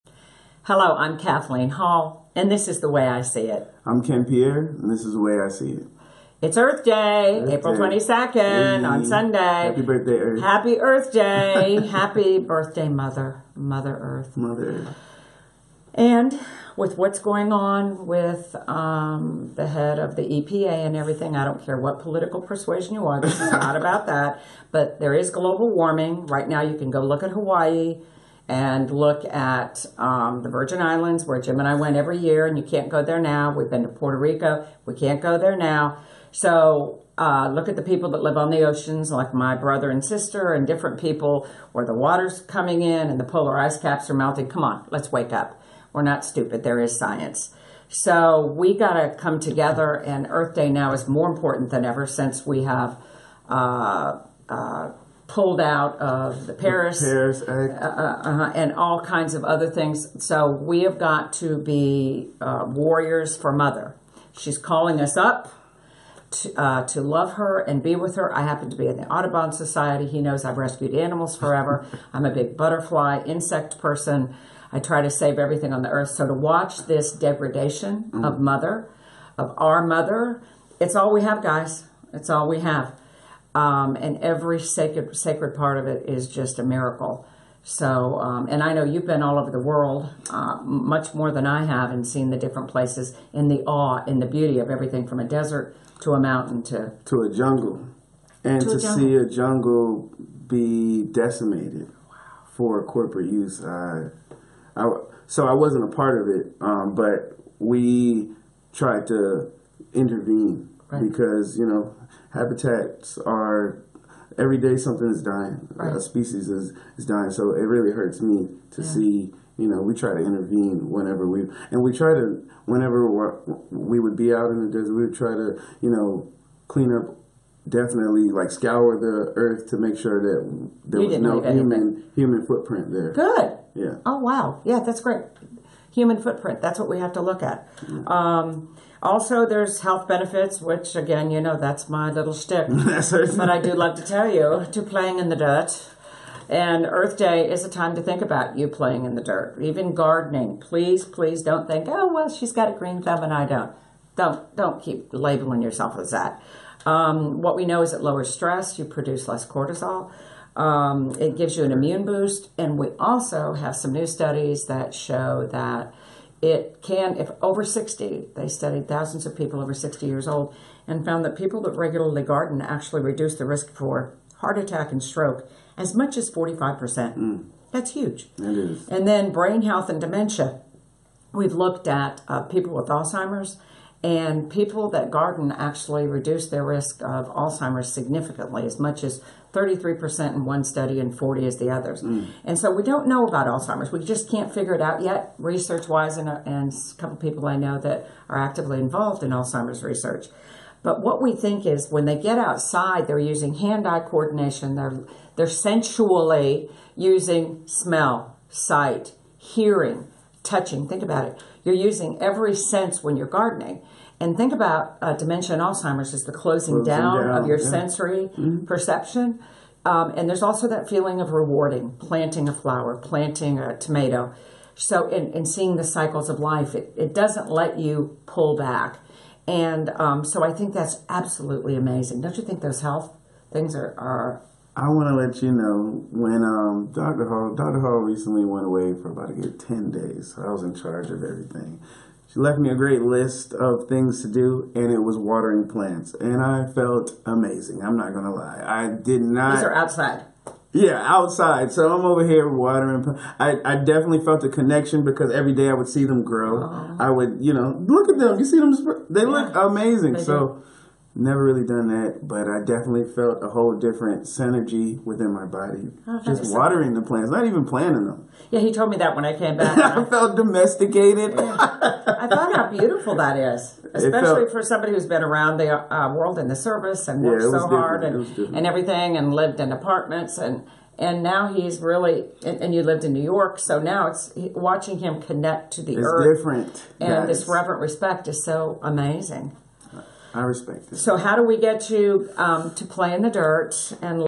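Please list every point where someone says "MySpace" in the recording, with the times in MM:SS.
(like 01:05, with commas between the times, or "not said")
not said.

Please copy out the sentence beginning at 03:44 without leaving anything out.
So, in, in seeing the cycles of life, it, it doesn't let you pull back.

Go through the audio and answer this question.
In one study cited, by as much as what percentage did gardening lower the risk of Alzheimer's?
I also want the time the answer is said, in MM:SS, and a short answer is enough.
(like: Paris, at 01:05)
33%, at 03:09.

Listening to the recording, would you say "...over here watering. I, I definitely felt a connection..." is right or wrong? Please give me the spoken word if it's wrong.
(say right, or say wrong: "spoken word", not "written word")
right.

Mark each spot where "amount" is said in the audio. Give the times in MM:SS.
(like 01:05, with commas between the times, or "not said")
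not said.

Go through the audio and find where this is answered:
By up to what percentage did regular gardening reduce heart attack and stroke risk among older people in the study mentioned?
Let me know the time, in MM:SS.
02:56.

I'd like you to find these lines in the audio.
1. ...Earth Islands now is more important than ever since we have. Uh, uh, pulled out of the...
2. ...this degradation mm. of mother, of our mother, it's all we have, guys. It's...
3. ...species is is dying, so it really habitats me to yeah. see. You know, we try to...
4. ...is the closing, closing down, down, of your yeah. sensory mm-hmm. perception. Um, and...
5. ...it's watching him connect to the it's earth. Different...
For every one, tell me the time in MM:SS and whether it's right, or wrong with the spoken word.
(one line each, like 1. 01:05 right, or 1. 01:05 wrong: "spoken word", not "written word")
1. 00:50 wrong: "Day", not "Islands"
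2. 01:16 right
3. 01:56 wrong: "hurts", not "habitats"
4. 03:36 right
5. 04:44 right.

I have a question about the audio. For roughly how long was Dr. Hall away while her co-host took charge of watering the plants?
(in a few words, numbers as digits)
10 days.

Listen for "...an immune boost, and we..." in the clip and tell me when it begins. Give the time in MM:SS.
02:41.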